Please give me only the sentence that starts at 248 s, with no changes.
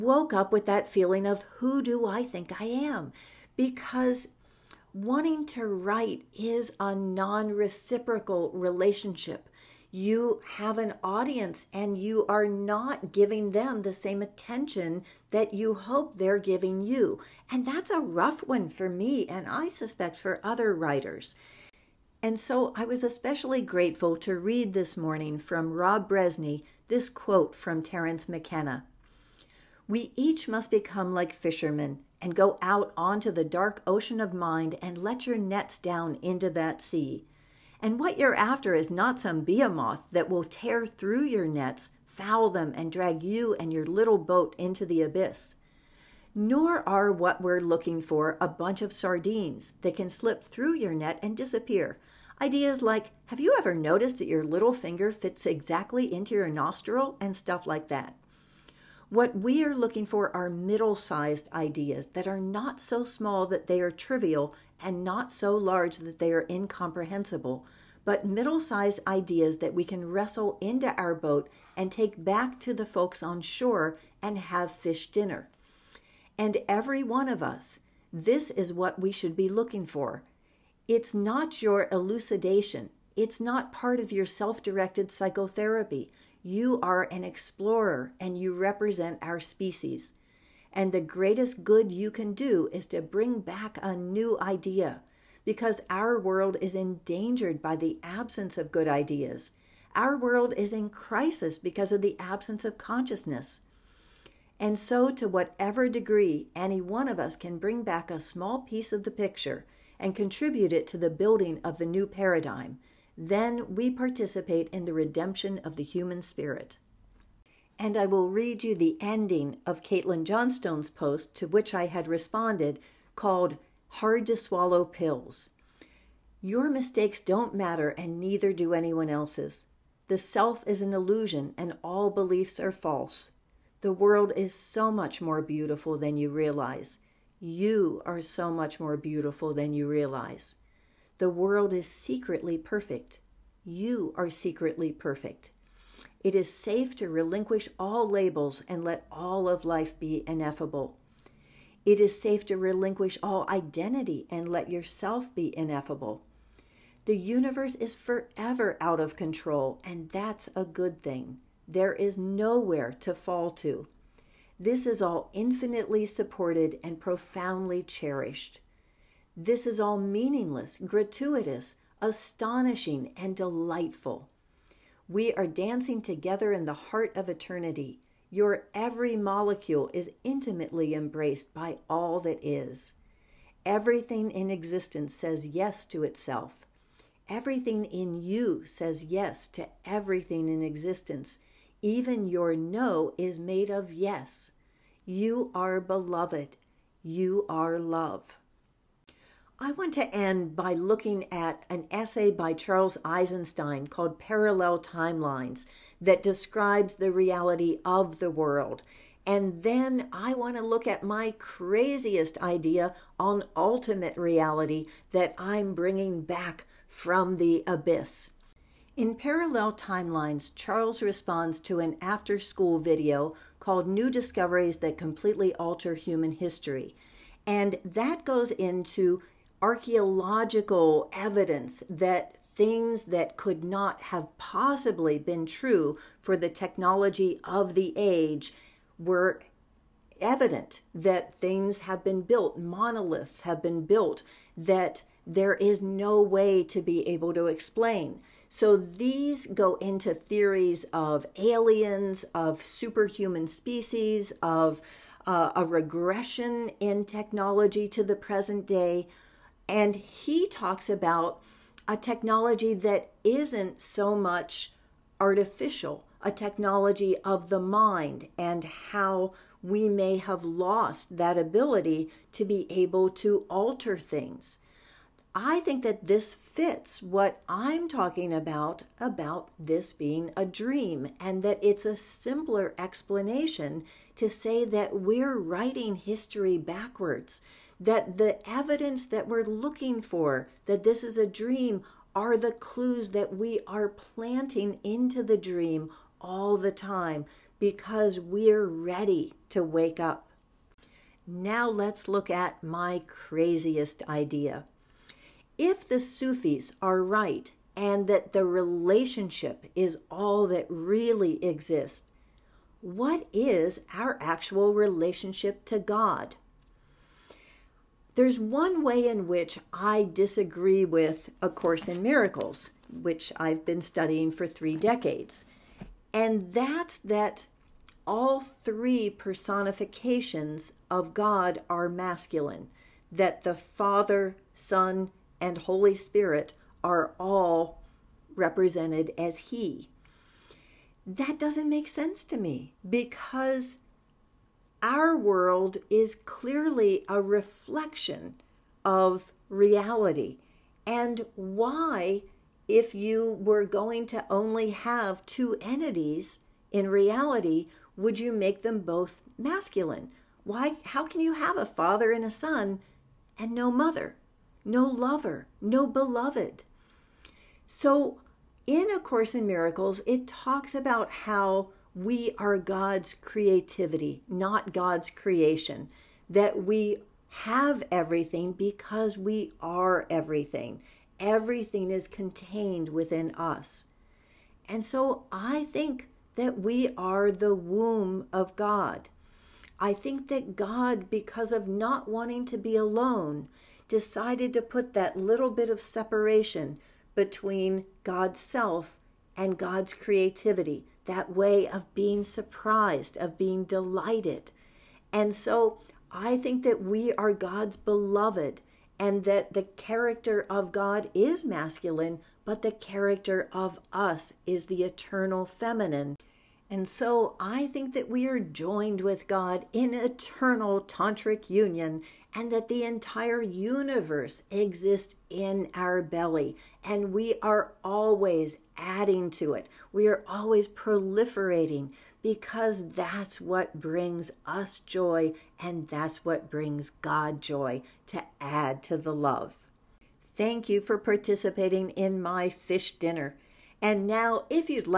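So these go into theories of aliens, of superhuman species, of uh, a regression in technology to the present day.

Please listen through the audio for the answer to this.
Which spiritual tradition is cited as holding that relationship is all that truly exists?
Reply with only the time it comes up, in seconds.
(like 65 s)
305 s.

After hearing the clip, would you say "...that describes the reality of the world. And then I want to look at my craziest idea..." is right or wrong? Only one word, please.
right.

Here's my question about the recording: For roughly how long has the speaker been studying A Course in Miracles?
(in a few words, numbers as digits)
3 decades.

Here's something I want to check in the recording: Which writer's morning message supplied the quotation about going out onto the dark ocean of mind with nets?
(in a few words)
Rob Brezsny.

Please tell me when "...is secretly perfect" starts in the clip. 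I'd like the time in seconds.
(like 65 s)
141 s.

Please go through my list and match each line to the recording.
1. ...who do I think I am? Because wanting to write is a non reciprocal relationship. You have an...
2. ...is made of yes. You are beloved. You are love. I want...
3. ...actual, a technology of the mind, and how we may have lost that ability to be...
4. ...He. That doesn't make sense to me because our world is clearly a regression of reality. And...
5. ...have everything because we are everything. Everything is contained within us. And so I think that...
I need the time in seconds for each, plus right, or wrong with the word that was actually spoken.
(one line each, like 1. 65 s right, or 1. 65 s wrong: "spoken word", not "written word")
1. 1 s right
2. 193 s right
3. 265 s wrong: "artificial", not "actual"
4. 339 s wrong: "reflection", not "regression"
5. 377 s right.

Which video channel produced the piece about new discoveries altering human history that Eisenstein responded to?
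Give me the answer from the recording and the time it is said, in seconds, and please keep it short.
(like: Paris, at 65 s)
After Skool, at 222 s.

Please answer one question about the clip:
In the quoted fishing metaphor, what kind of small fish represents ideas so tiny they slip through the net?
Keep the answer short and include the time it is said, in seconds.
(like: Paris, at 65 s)
sardines, at 48 s.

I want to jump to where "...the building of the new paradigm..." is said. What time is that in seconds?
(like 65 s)
110 s.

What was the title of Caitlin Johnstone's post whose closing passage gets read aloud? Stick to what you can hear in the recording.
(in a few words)
Hard to Swallow Pills.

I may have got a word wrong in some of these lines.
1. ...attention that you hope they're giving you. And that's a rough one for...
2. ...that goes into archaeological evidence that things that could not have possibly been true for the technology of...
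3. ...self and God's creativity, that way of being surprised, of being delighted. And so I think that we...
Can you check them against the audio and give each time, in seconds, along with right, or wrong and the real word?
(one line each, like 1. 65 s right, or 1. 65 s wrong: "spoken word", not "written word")
1. 14 s right
2. 227 s right
3. 398 s right.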